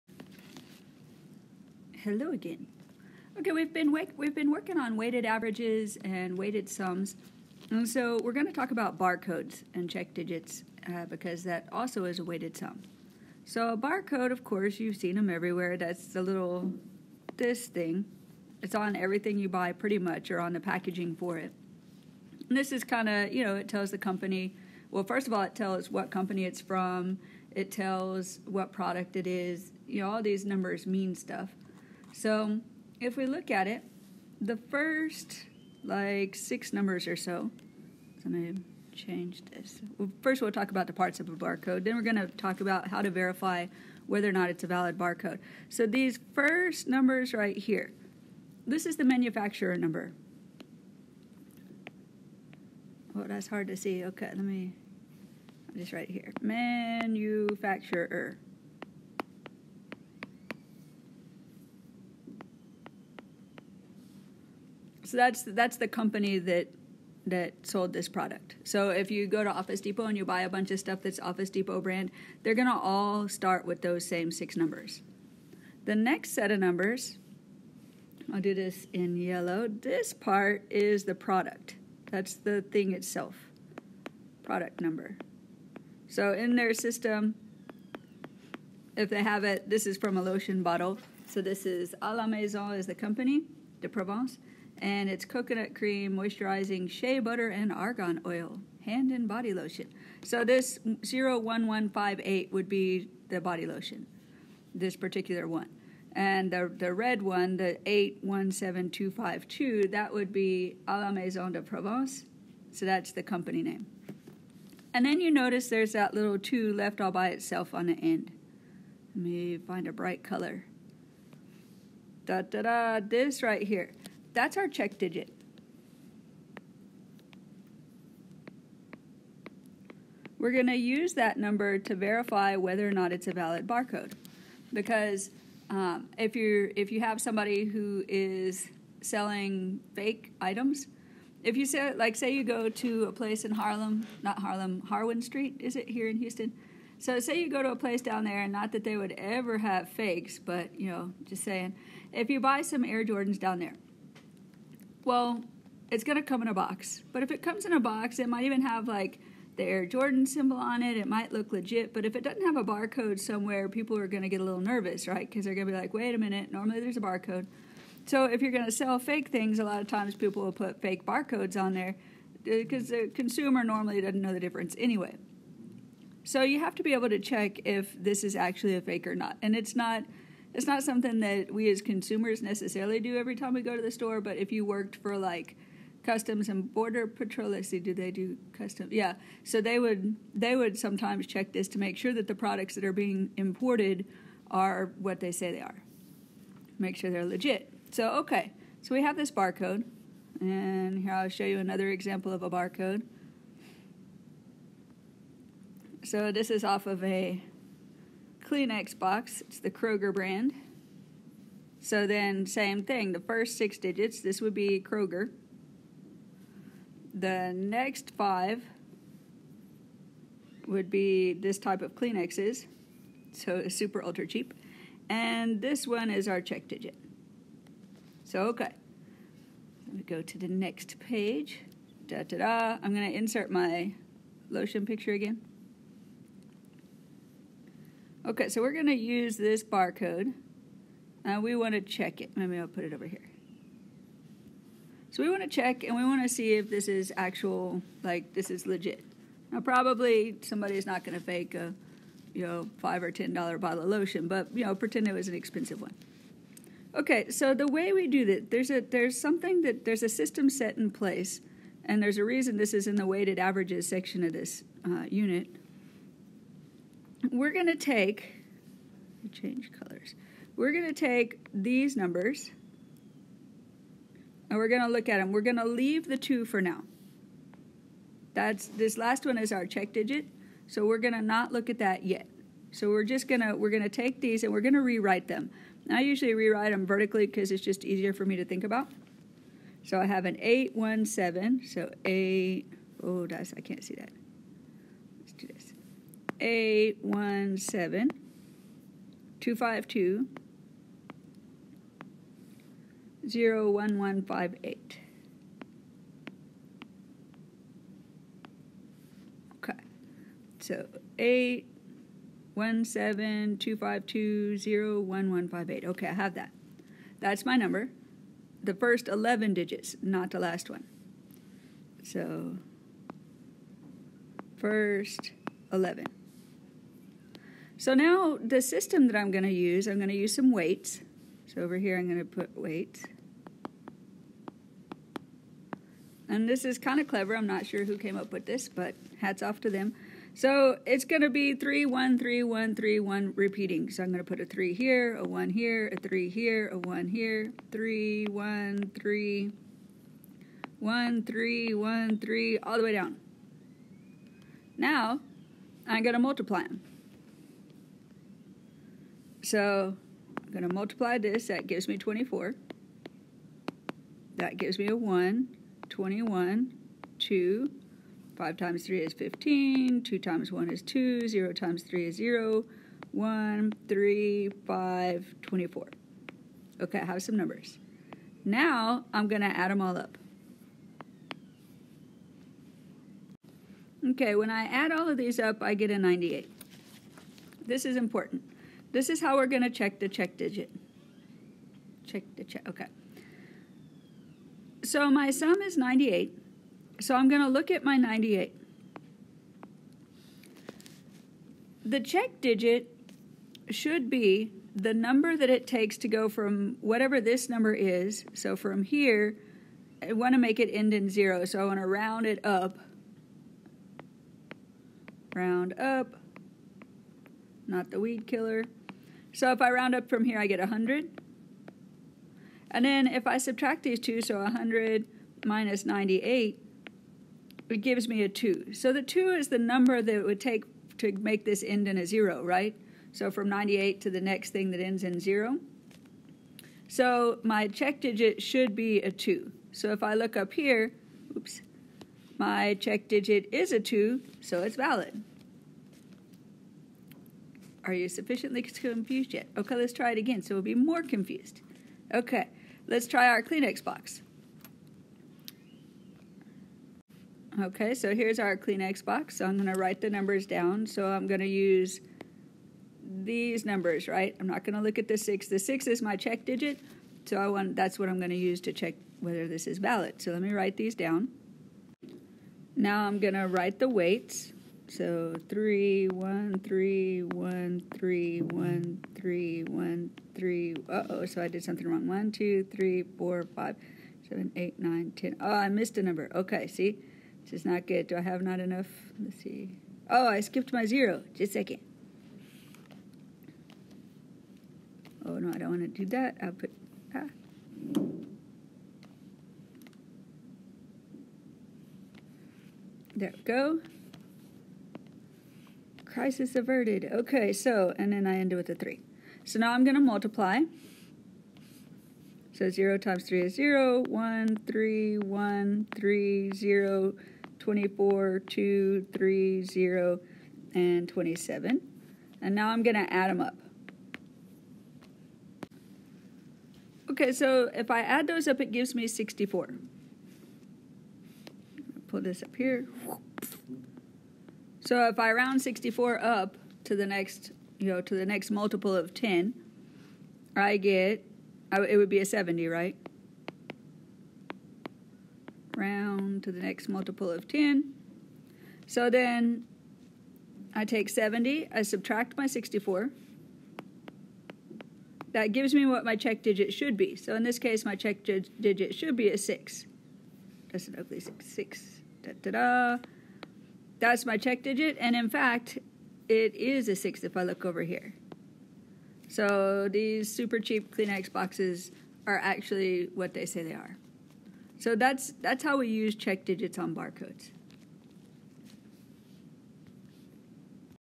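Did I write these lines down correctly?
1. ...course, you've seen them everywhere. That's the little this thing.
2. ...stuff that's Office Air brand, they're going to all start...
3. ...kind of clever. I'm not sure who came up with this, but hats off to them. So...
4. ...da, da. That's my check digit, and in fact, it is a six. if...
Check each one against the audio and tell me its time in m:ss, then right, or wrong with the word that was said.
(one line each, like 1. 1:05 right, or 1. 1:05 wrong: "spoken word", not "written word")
1. 0:14 right
2. 1:10 wrong: "Depot", not "Air"
3. 5:36 right
4. 9:22 right.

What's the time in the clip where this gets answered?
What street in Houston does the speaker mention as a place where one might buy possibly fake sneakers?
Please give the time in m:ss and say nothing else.
2:24.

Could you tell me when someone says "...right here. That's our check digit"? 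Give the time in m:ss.
2:03.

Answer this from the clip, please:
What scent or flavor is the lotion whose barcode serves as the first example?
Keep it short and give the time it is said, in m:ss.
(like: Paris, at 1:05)
coconut cream, at 1:35.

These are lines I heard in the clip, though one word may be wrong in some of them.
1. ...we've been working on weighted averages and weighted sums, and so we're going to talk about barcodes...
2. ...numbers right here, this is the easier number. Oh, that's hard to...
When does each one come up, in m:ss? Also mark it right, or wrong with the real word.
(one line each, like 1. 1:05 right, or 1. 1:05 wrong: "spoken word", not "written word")
1. 0:03 right
2. 0:46 wrong: "manufacturer", not "easier".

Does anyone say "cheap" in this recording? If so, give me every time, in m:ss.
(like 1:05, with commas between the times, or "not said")
3:44, 9:30.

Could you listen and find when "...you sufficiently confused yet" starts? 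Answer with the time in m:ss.
7:27.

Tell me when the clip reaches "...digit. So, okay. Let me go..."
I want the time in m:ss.
3:46.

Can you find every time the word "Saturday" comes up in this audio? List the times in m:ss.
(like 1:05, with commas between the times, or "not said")
not said.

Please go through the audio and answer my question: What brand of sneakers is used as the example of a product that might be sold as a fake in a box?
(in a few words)
Air Jordans.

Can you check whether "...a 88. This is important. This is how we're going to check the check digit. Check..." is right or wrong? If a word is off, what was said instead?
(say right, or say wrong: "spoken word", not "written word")
wrong: "98", not "88".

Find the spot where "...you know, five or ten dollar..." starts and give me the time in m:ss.
4:12.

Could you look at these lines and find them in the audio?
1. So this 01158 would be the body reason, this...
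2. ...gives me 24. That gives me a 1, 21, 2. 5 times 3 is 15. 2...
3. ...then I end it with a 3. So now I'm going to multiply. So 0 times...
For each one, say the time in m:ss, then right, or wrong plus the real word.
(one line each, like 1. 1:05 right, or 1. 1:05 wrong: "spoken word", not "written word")
1. 1:40 wrong: "lotion", not "reason"
2. 6:01 right
3. 8:28 right.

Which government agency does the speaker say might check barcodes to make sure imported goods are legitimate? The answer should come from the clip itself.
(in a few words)
customs and border patrol.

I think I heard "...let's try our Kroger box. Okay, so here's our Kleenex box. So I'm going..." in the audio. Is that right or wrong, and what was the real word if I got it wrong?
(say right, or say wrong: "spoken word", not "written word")
wrong: "Kleenex", not "Kroger".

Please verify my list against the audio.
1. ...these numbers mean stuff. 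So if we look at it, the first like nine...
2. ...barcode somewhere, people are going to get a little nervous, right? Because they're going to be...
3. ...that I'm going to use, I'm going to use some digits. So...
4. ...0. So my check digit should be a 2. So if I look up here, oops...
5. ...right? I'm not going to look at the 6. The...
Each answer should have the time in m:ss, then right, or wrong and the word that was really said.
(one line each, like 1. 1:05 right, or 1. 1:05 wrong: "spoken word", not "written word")
1. 0:30 wrong: "six", not "nine"
2. 2:42 right
3. 5:29 wrong: "weights", not "digits"
4. 7:15 right
5. 7:44 right.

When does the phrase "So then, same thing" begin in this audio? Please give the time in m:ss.
3:31.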